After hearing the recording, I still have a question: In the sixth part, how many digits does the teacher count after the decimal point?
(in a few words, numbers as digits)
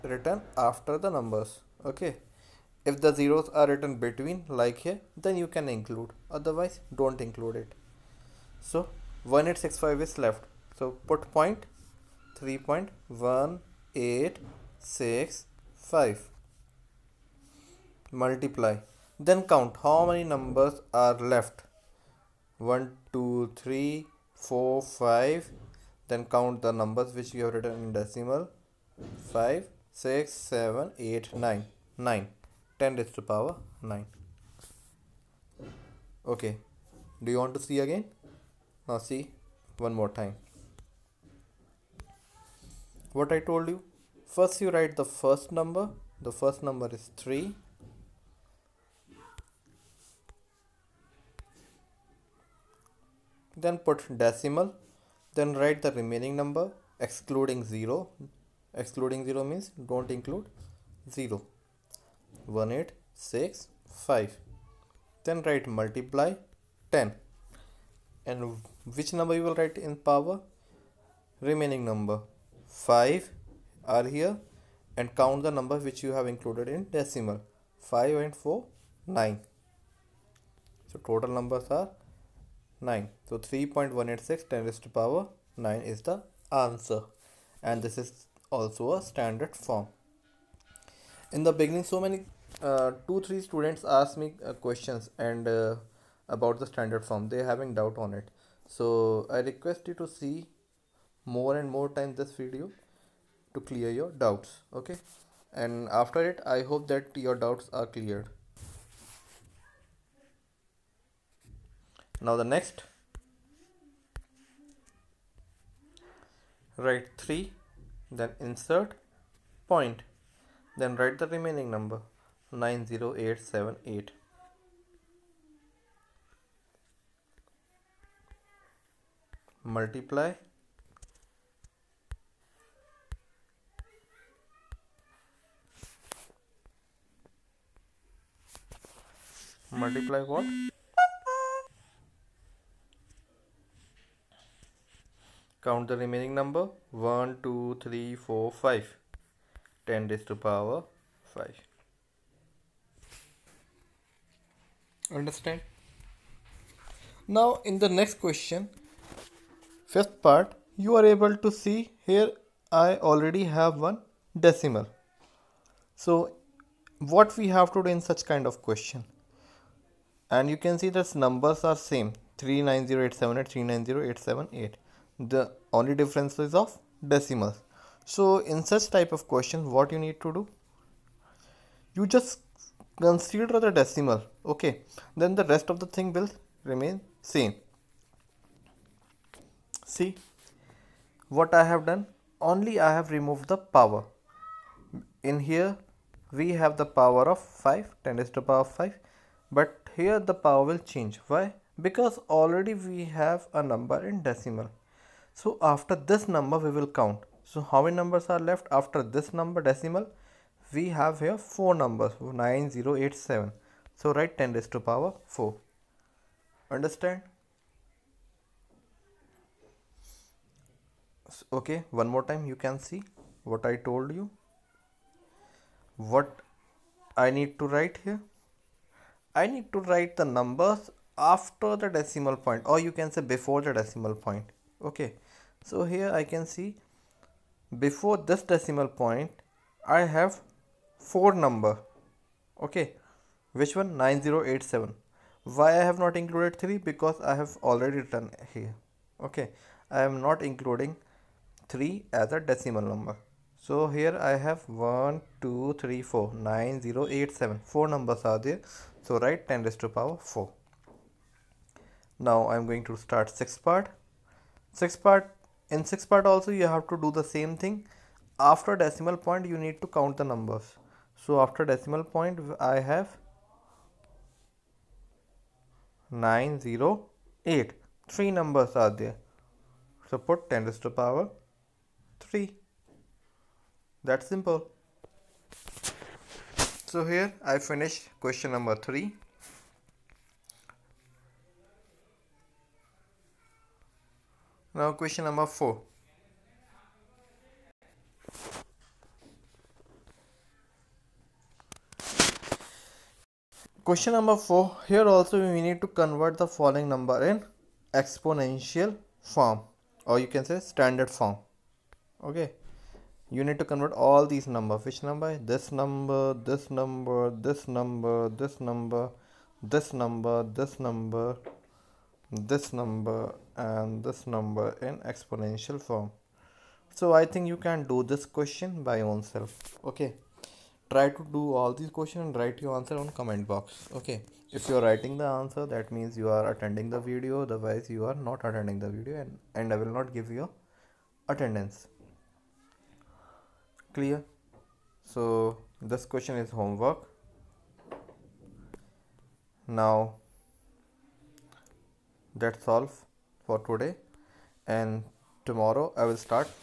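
3.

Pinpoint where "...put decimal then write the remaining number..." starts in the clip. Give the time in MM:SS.
00:53.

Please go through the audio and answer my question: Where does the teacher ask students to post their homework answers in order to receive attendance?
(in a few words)
comment box.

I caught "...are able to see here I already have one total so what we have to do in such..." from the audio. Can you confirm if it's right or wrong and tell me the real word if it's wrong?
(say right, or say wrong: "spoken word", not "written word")
wrong: "decimal", not "total".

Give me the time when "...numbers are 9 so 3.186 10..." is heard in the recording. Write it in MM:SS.
01:21.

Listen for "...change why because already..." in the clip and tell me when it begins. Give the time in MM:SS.
03:20.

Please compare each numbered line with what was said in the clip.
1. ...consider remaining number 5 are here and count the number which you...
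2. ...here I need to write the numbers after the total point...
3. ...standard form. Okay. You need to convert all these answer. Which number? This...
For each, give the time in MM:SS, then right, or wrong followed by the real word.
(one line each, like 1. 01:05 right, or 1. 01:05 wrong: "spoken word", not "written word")
1. 01:10 wrong: "power", not "consider"
2. 03:48 wrong: "decimal", not "total"
3. 05:10 wrong: "number", not "answer".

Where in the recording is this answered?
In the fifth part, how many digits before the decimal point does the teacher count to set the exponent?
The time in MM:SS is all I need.
03:59.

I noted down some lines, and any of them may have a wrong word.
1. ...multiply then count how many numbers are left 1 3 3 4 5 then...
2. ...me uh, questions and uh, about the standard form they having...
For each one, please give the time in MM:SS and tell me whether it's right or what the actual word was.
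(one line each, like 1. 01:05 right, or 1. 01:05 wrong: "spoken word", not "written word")
1. 00:18 wrong: "2", not "3"
2. 01:34 right.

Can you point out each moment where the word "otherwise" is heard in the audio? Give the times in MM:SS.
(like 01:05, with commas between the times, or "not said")
00:06, 05:37.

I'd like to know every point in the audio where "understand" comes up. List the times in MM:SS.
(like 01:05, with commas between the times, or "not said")
02:35, 03:36.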